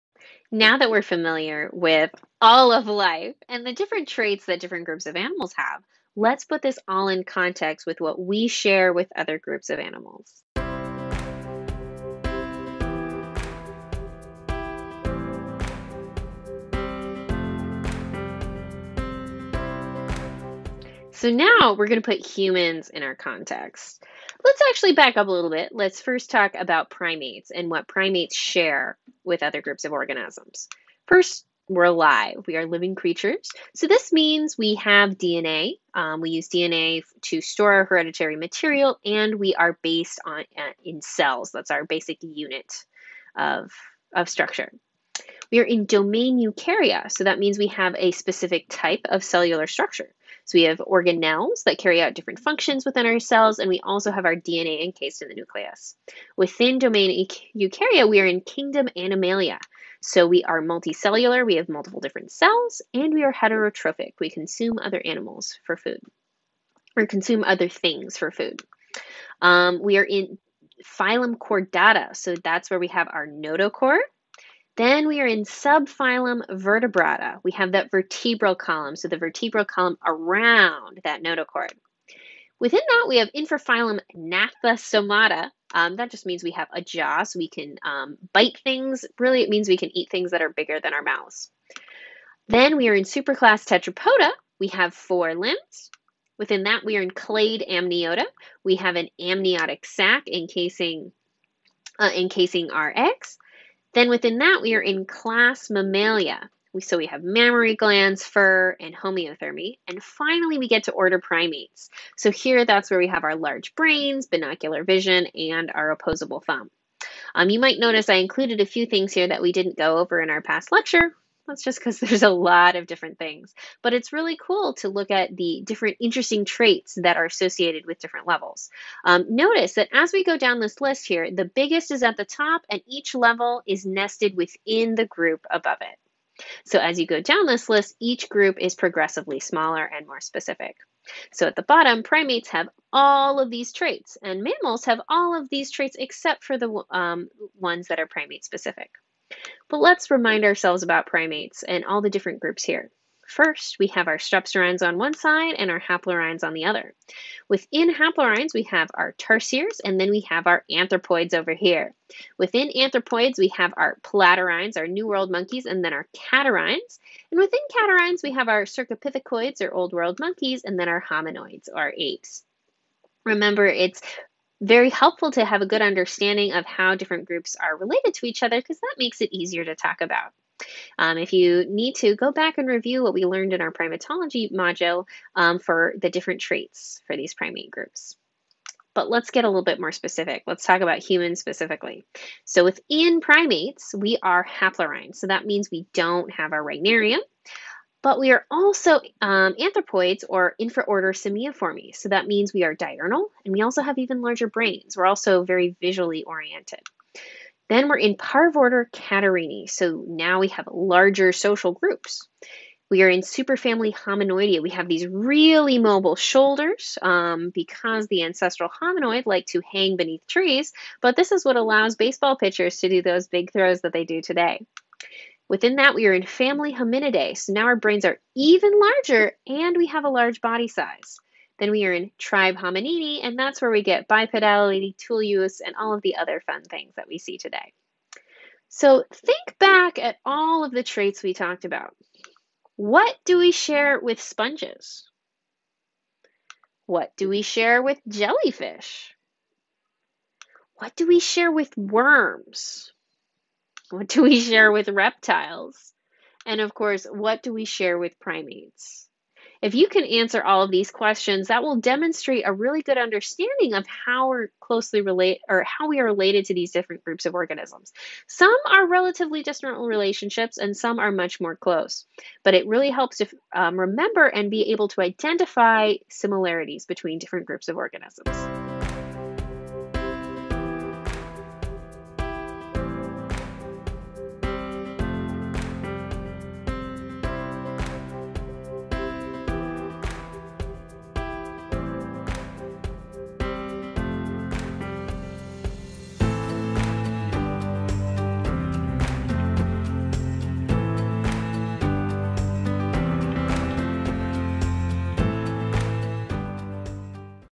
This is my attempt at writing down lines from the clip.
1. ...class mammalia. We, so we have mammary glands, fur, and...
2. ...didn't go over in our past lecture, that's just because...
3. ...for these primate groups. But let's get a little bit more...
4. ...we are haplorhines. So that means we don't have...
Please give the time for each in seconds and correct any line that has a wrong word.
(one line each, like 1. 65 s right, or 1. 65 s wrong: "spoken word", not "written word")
1. 105 s right
2. 119 s right
3. 187 s right
4. 193 s right.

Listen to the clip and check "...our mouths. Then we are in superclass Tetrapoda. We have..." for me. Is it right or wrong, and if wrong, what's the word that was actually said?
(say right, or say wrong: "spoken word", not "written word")
right.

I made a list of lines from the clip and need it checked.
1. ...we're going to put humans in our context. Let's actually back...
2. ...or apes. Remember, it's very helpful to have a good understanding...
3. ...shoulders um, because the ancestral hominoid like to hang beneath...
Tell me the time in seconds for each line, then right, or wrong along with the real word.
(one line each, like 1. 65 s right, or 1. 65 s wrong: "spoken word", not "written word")
1. 21 s right
2. 171 s right
3. 216 s right.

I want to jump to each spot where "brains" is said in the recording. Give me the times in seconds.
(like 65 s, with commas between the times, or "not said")
113 s, 204 s, 227 s.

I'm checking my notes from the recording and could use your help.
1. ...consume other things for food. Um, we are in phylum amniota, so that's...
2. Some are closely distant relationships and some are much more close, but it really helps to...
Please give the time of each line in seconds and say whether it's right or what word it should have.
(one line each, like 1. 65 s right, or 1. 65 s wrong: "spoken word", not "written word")
1. 67 s wrong: "chordata", not "amniota"
2. 268 s wrong: "relatively", not "closely".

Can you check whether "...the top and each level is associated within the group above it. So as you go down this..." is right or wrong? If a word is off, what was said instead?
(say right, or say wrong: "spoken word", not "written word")
wrong: "nested", not "associated".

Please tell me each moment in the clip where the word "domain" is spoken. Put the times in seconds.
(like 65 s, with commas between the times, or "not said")
45 s, 56 s.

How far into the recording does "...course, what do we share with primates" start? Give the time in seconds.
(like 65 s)
256 s.